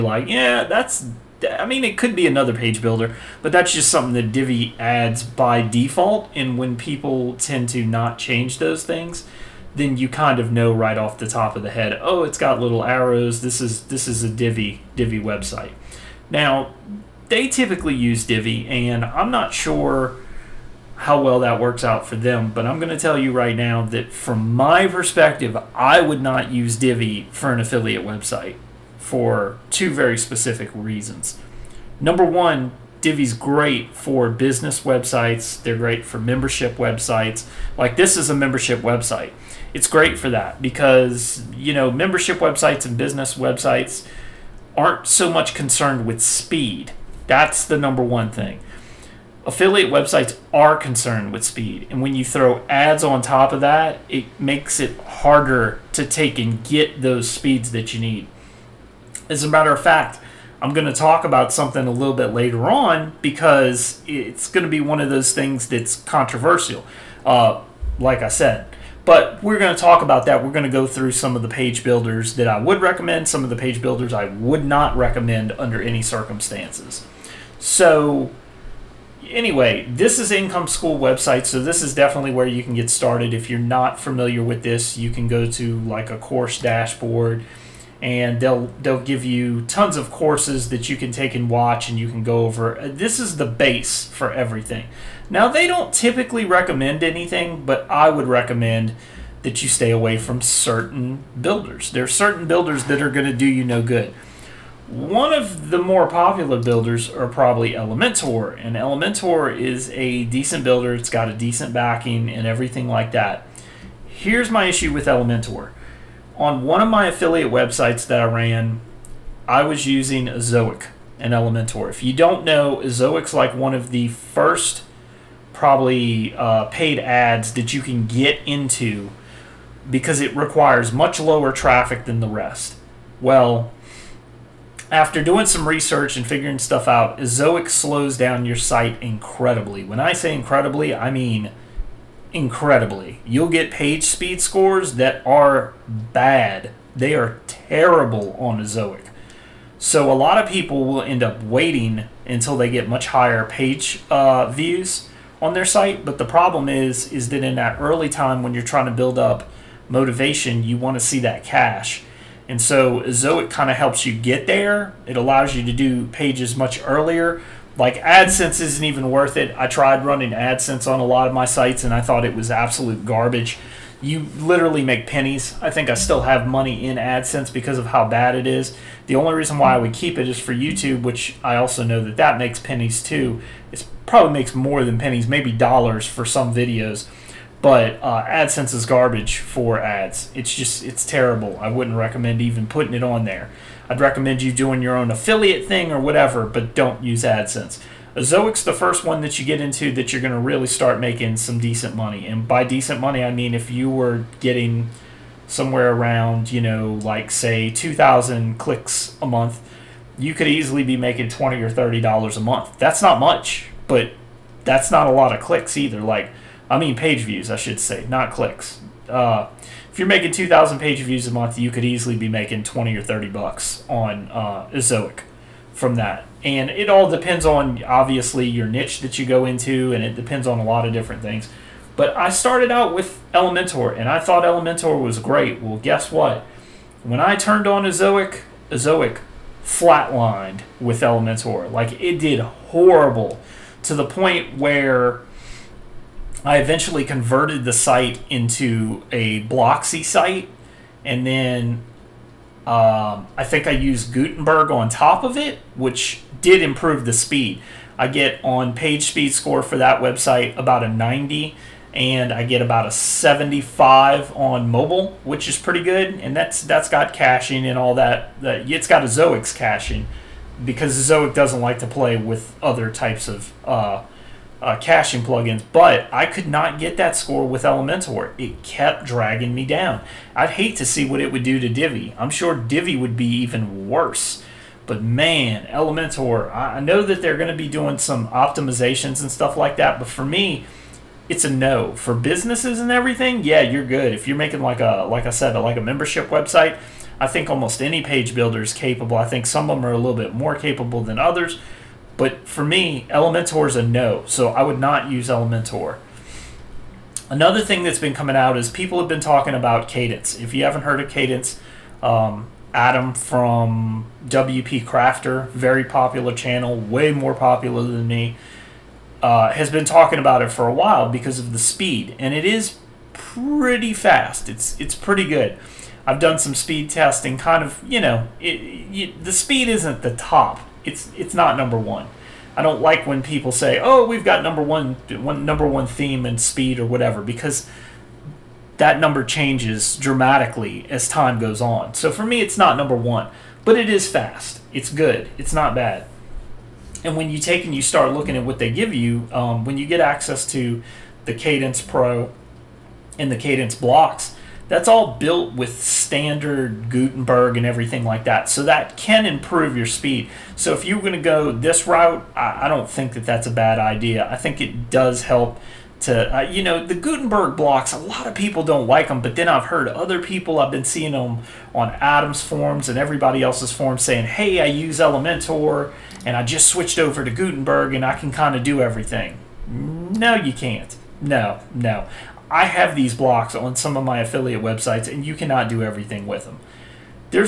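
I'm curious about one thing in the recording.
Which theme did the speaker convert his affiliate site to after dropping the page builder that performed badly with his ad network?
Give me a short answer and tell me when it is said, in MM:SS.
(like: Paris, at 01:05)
Blocksy, at 04:09.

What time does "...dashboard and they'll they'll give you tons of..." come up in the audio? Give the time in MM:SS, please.
01:26.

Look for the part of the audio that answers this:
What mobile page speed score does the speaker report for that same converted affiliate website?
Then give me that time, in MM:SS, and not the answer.
04:22.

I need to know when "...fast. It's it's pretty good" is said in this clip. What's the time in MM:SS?
05:23.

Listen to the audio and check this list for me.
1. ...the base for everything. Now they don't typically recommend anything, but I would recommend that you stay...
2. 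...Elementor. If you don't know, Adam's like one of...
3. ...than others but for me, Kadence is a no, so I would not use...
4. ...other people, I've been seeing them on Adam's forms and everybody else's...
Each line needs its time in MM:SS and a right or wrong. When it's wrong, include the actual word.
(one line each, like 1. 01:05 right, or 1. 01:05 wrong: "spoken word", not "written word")
1. 01:33 right
2. 02:01 wrong: "Ezoic", not "Adam"
3. 05:01 wrong: "Elementor", not "Kadence"
4. 06:09 right.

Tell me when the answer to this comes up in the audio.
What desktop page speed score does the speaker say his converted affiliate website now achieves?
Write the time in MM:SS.
04:20.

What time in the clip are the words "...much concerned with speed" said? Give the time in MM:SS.
00:45.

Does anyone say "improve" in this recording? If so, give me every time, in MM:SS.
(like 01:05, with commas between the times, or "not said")
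04:16, 05:59.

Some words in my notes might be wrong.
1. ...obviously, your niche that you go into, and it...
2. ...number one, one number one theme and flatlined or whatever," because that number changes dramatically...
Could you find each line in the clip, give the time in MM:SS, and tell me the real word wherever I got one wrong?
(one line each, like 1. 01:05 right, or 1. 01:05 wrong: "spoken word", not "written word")
1. 03:47 right
2. 05:34 wrong: "speed", not "flatlined".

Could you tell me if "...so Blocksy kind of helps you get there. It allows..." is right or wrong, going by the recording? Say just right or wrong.
wrong.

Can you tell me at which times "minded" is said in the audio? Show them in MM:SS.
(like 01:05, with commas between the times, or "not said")
not said.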